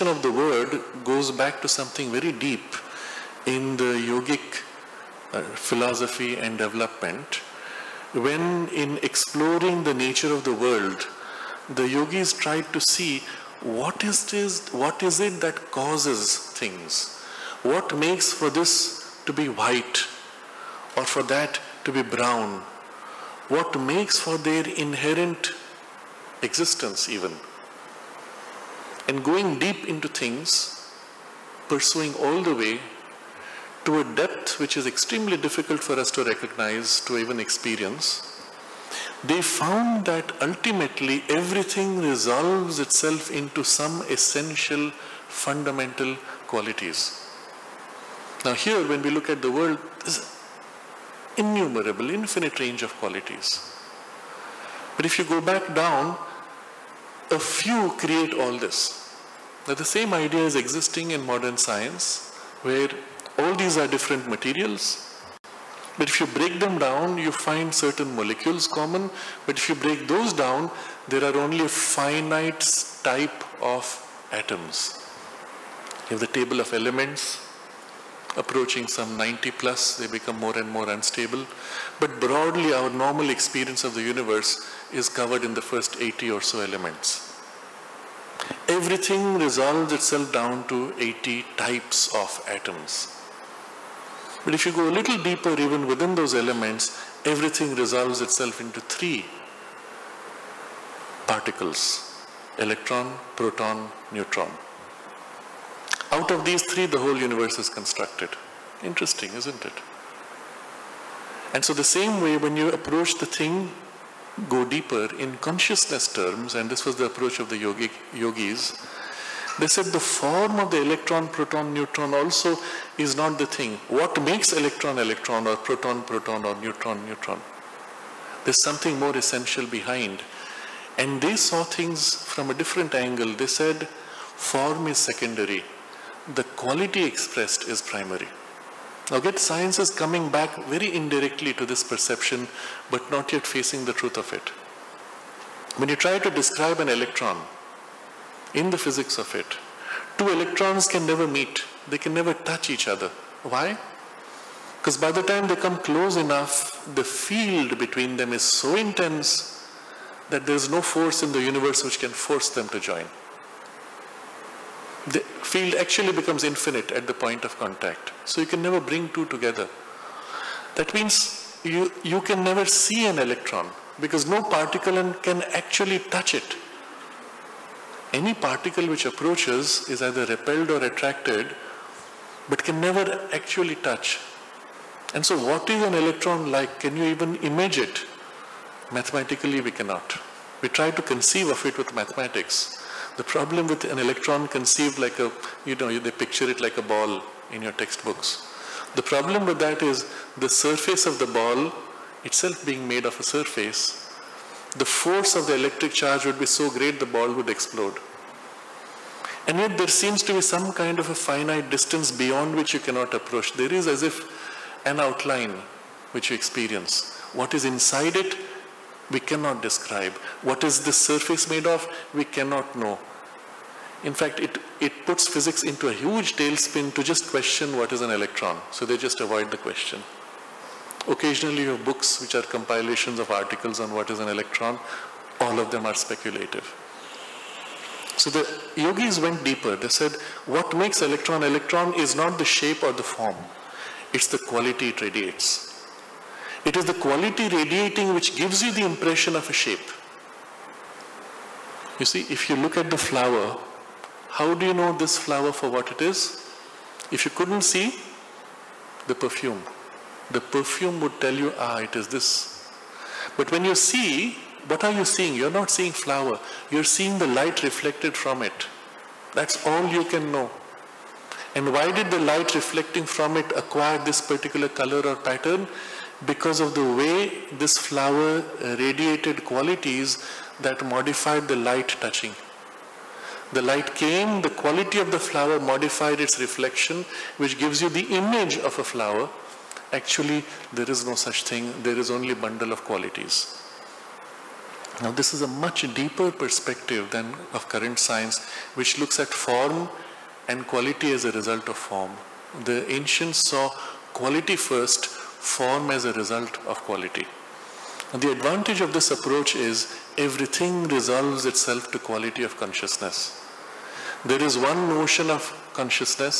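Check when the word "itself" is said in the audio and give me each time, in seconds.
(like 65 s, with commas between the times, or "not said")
42 s, 89 s, 98 s, 202 s, 311 s.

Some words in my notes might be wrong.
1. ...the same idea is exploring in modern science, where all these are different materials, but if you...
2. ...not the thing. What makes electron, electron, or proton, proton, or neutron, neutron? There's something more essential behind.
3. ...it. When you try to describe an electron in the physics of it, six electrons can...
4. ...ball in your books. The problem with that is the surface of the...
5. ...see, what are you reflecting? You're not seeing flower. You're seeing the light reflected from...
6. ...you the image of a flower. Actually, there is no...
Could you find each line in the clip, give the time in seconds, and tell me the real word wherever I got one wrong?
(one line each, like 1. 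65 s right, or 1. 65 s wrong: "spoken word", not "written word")
1. 59 s wrong: "existing", not "exploring"
2. 123 s right
3. 144 s wrong: "two", not "six"
4. 196 s wrong: "textbooks", not "books"
5. 263 s wrong: "seeing", not "reflecting"
6. 287 s right.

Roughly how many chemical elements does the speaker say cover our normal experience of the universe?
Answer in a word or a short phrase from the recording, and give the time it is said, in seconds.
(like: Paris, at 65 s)
80, at 85 s.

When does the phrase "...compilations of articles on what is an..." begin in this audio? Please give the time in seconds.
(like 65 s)
232 s.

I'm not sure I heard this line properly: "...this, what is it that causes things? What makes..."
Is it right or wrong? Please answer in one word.
right.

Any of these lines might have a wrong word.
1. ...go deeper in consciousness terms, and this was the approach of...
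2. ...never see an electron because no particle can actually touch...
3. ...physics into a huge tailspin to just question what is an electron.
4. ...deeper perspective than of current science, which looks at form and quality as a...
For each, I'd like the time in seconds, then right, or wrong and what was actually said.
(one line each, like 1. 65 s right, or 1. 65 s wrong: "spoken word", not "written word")
1. 114 s right
2. 172 s right
3. 225 s right
4. 295 s right.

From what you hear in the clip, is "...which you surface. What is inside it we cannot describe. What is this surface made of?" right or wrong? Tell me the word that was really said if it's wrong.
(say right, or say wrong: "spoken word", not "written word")
wrong: "experience", not "surface".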